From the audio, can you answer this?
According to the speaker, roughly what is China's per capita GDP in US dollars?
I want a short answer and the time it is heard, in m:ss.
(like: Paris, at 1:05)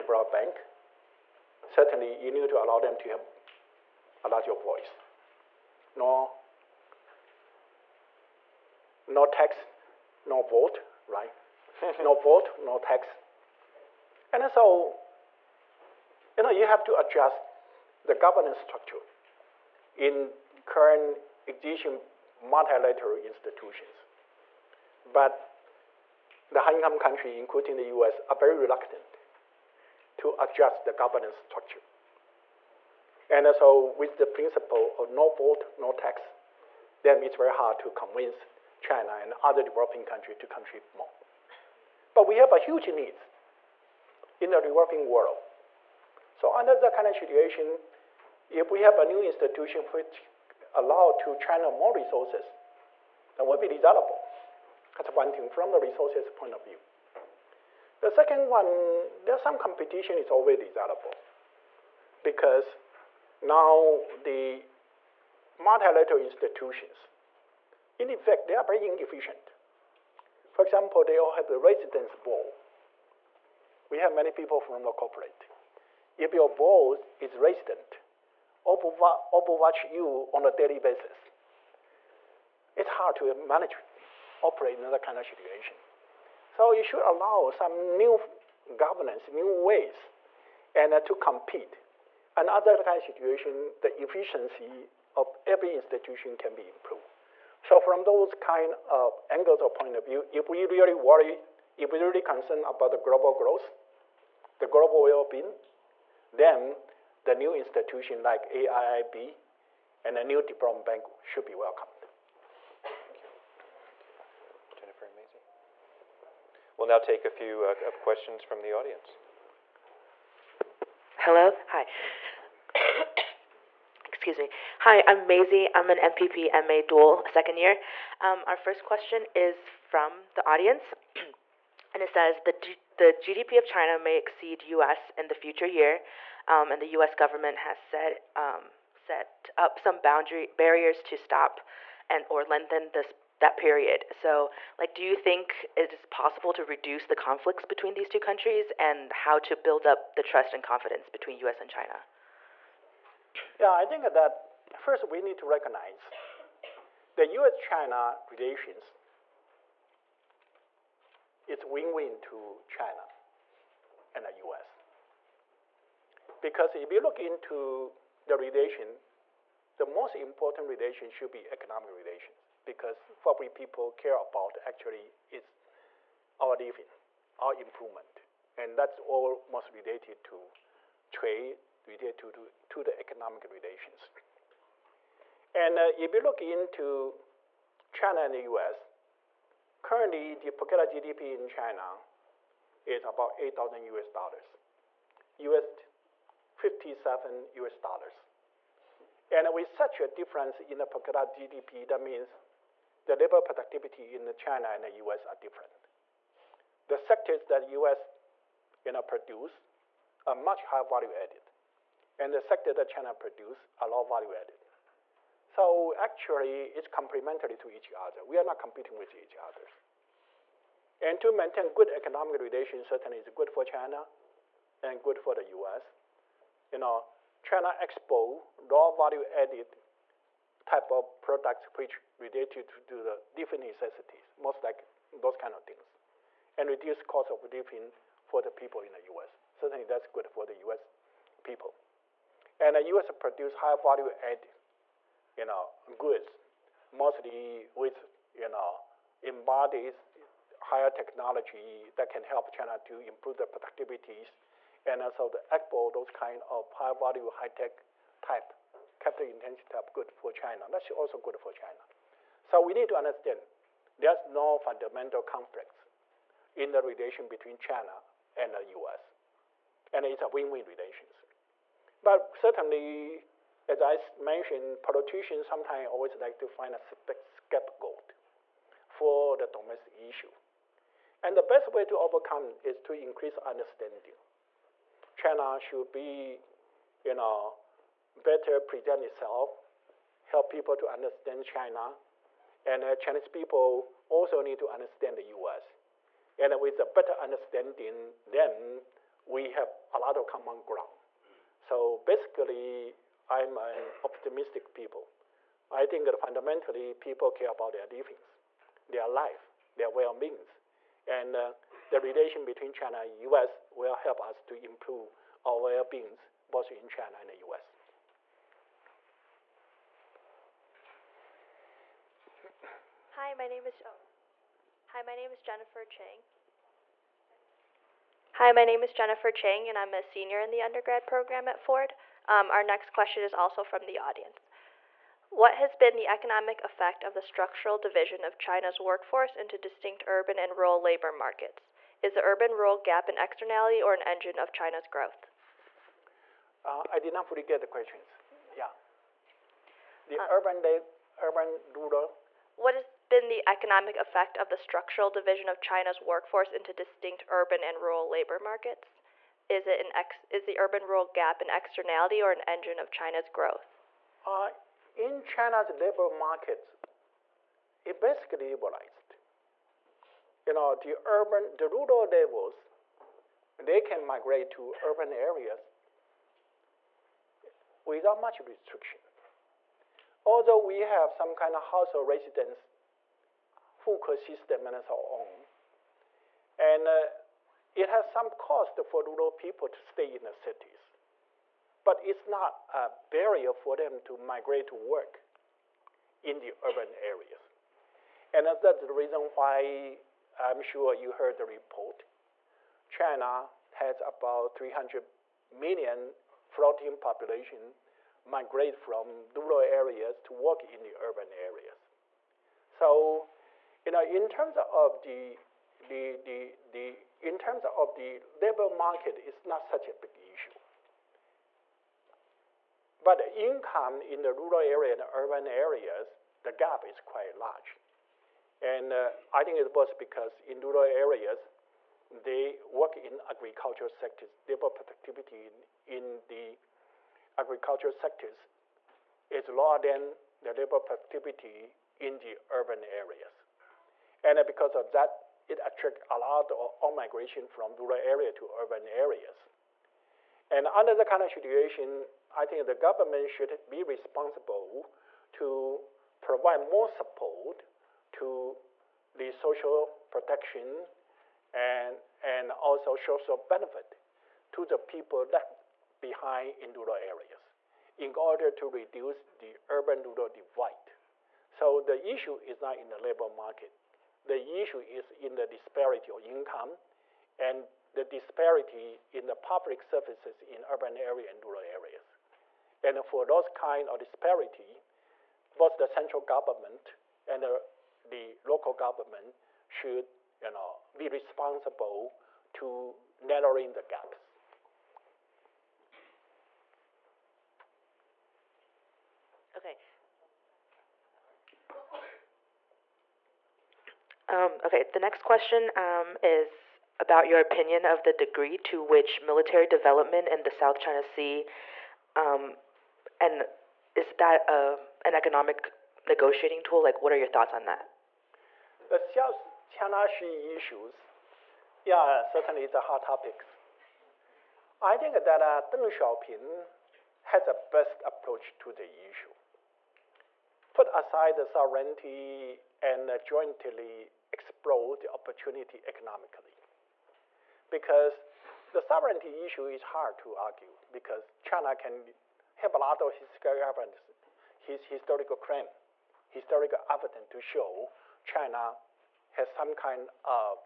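8,000, at 3:13.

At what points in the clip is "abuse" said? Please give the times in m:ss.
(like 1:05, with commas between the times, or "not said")
not said.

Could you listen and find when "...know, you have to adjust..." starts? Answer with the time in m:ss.
0:16.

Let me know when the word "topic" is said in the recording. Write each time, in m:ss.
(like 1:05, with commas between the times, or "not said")
8:43.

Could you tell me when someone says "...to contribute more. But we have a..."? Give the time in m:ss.
0:40.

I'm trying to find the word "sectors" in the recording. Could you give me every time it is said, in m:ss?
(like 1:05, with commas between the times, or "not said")
3:26, 3:32, 7:13, 7:17.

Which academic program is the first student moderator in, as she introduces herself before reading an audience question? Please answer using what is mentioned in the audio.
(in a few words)
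MPP MA dual.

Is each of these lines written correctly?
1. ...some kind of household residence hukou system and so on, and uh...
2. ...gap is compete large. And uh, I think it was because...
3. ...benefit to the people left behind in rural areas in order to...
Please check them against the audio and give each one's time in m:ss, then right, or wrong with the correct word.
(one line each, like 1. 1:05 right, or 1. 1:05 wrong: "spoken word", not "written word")
1. 6:21 right
2. 7:06 wrong: "quite", not "compete"
3. 7:43 right.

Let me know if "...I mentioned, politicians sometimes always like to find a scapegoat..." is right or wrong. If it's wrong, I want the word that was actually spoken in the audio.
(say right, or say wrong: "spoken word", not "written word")
right.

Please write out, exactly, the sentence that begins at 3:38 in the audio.
We are not competing with each other.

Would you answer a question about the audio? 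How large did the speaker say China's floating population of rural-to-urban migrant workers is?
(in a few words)
300 million.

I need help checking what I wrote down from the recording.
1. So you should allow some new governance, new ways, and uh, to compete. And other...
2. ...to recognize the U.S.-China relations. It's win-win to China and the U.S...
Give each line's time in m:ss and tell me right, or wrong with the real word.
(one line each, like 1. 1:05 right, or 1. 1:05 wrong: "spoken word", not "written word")
1. 1:26 right
2. 2:35 right.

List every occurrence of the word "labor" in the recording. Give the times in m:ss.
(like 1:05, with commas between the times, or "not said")
3:23, 5:40, 5:58, 6:05, 6:58, 7:14, 7:20, 7:52.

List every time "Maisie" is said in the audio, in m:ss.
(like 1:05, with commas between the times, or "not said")
1:55, 2:05.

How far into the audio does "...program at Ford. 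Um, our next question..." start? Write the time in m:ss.
5:31.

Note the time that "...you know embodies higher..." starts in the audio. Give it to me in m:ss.
4:08.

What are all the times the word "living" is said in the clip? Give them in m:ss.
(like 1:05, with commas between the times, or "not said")
2:56, 3:57, 5:07.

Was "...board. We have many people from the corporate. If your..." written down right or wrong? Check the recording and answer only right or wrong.
right.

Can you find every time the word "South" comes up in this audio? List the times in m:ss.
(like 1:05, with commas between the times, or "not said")
8:30, 8:38.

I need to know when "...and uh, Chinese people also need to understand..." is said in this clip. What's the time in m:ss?
4:52.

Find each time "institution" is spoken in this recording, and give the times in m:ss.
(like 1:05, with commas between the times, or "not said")
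0:23, 0:49, 1:06, 1:35, 1:47.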